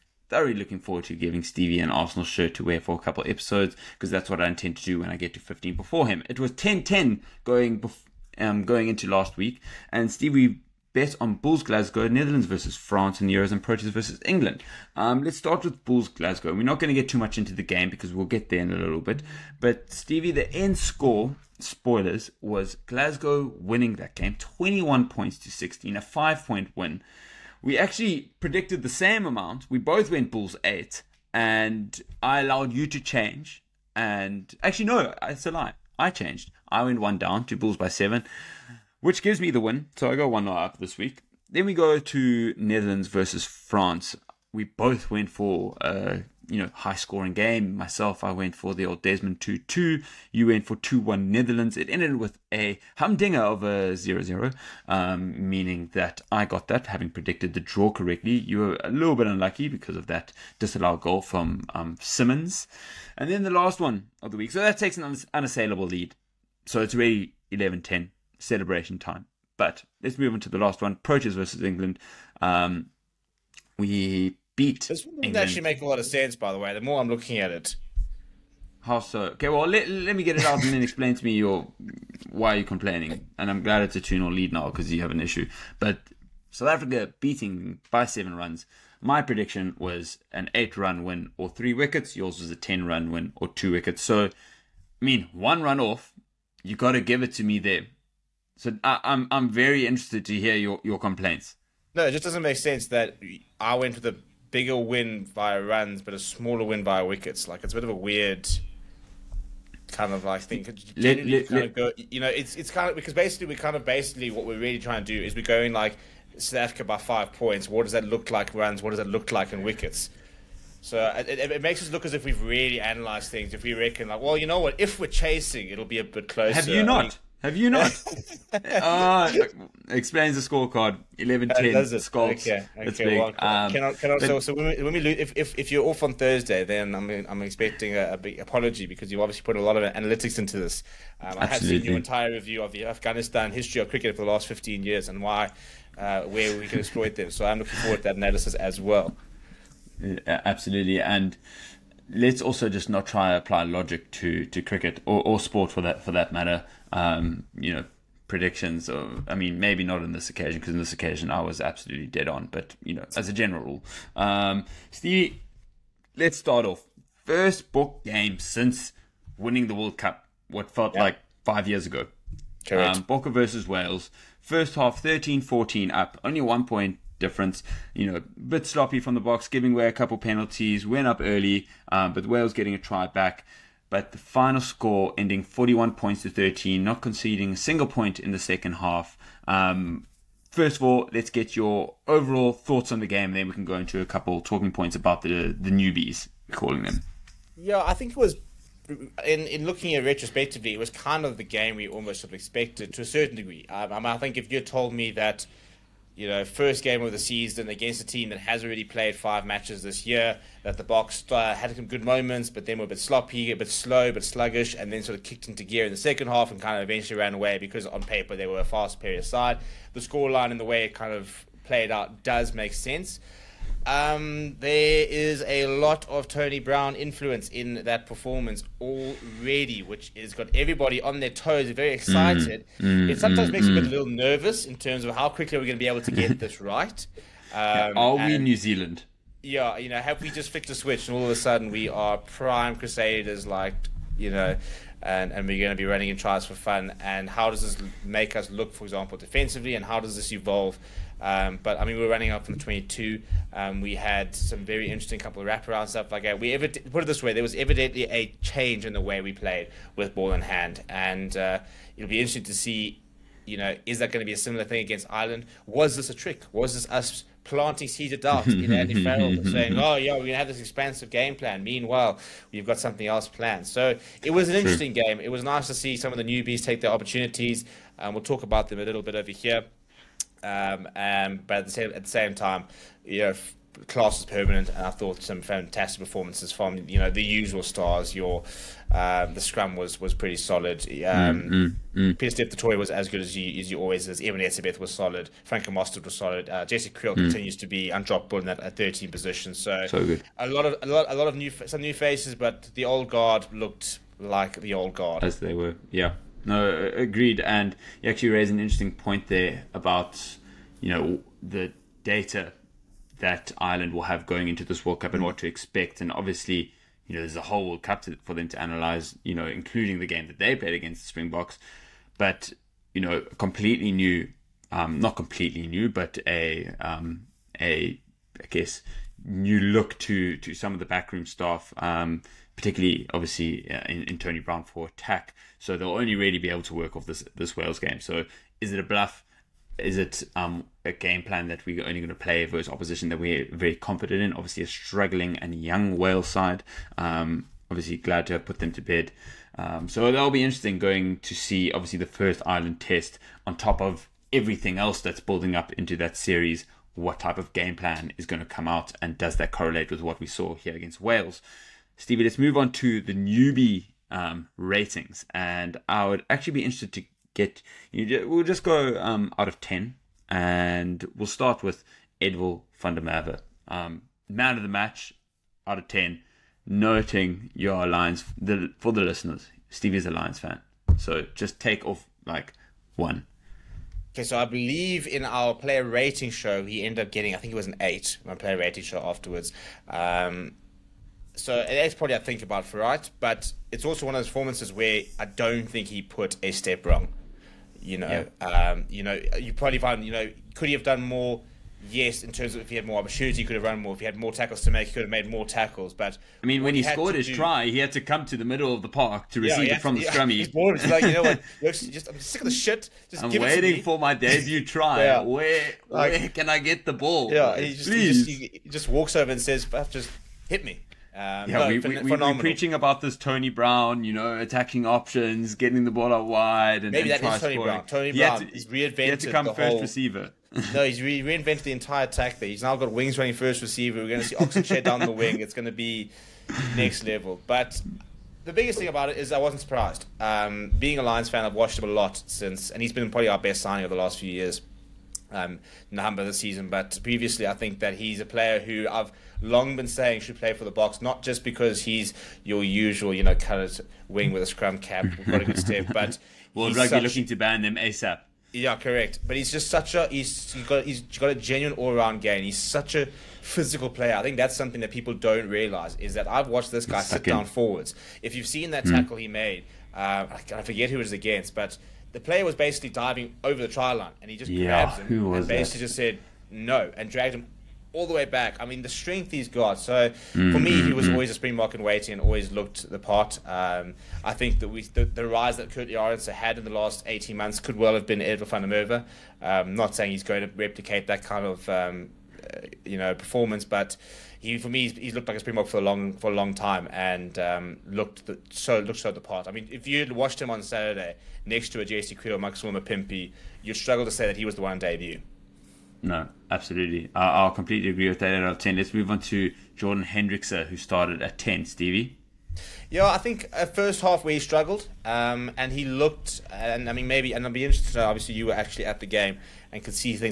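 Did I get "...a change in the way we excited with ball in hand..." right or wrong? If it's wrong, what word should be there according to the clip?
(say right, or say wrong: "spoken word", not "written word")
wrong: "played", not "excited".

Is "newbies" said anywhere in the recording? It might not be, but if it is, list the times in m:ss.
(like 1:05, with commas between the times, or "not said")
3:15, 4:36, 6:03.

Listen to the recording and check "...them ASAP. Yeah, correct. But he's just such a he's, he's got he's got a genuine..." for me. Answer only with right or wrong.
right.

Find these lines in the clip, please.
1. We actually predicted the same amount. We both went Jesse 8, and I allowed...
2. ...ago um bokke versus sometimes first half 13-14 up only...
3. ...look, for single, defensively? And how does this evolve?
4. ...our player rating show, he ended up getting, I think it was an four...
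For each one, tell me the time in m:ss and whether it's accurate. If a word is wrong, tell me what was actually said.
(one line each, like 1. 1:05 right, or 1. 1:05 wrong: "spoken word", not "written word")
1. 0:27 wrong: "Bulls", not "Jesse"
2. 2:51 wrong: "wales", not "sometimes"
3. 4:08 wrong: "example", not "single"
4. 6:25 wrong: "eight", not "four".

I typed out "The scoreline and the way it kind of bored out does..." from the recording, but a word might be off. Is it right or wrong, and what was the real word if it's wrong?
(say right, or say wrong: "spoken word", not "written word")
wrong: "played", not "bored".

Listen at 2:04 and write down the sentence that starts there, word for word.
If we're chasing, it'll be a bit closer.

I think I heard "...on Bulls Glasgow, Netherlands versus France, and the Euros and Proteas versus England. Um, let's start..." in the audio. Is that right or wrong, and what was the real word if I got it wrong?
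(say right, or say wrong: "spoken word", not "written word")
right.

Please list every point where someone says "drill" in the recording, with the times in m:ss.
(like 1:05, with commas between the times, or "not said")
not said.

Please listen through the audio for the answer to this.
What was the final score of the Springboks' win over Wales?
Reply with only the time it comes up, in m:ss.
3:05.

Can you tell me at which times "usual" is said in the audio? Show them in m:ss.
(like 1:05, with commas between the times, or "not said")
4:47, 7:32.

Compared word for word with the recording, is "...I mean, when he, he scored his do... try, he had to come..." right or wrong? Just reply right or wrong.
right.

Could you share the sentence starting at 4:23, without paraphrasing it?
You know, is that going to be a similar thing against Ireland?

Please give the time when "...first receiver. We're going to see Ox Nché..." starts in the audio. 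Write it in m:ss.
7:13.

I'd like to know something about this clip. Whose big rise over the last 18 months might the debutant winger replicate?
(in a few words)
Kurt Jorgensen.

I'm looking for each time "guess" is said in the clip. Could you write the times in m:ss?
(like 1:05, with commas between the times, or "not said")
5:28.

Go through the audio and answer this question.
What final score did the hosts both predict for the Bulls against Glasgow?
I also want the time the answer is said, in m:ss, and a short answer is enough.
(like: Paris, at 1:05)
21 to 16, at 0:24.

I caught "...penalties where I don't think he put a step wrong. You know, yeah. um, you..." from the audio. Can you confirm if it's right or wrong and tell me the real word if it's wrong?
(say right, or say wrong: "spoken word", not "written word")
wrong: "performances", not "penalties".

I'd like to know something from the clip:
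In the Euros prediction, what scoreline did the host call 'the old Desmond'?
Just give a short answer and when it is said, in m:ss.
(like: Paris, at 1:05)
2 2, at 0:49.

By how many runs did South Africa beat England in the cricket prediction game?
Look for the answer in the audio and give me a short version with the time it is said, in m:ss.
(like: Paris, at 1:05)
7, at 1:28.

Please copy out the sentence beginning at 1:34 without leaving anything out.
So, I mean, one run off, you got to give it to me there.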